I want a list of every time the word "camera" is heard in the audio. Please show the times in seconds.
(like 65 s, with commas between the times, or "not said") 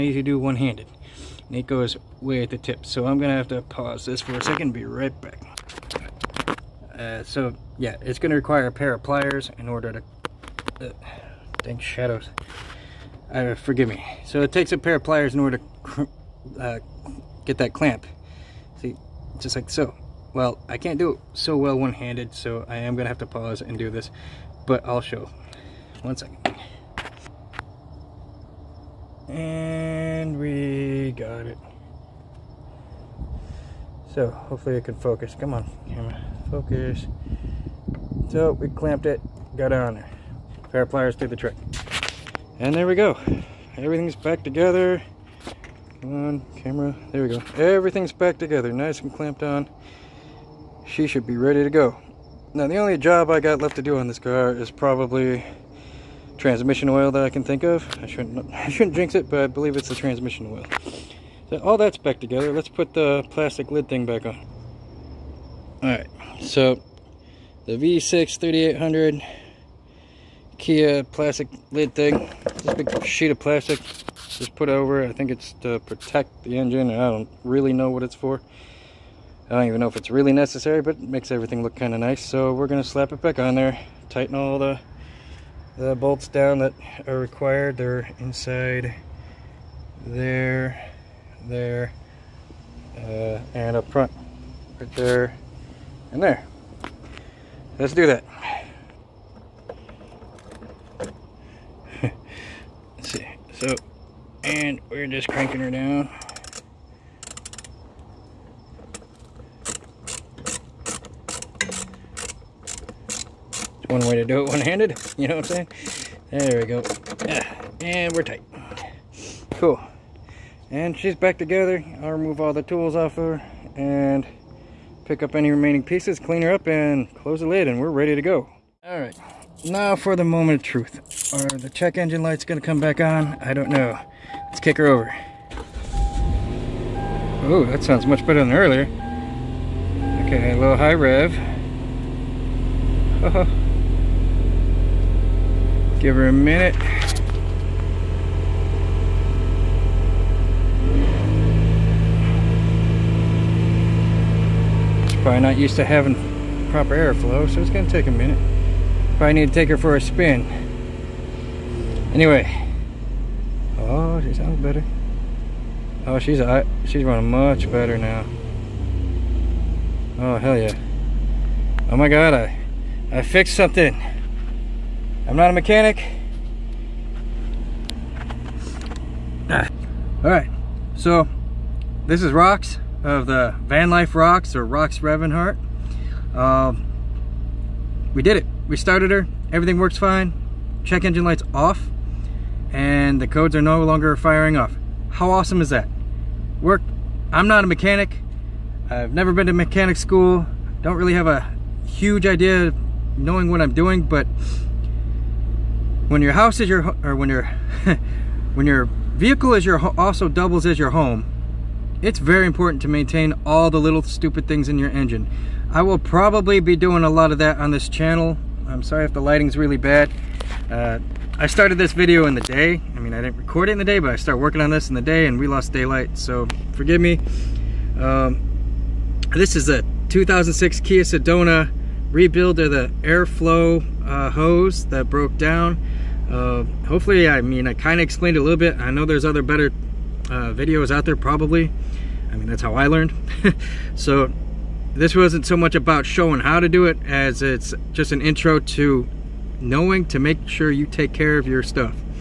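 35 s, 46 s.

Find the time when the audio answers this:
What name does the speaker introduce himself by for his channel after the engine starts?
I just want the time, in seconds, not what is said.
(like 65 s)
184 s.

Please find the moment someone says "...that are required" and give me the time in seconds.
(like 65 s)
86 s.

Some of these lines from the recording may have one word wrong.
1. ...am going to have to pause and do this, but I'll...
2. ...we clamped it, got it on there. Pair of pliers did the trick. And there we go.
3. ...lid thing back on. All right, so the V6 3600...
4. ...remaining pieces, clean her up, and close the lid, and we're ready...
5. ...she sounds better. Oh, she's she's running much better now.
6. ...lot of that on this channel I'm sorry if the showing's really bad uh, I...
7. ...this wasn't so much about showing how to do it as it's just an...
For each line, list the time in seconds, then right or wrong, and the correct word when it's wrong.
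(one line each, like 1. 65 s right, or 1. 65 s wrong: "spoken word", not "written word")
1. 22 s right
2. 38 s right
3. 63 s wrong: "3800", not "3600"
4. 125 s right
5. 164 s right
6. 217 s wrong: "lighting", not "showing"
7. 244 s right.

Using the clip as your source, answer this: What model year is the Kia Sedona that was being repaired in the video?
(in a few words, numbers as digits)
2006.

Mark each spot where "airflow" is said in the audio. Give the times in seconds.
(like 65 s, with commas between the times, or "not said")
156 s, 233 s.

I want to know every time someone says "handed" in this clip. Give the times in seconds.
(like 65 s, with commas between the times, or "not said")
0 s, 21 s, 114 s.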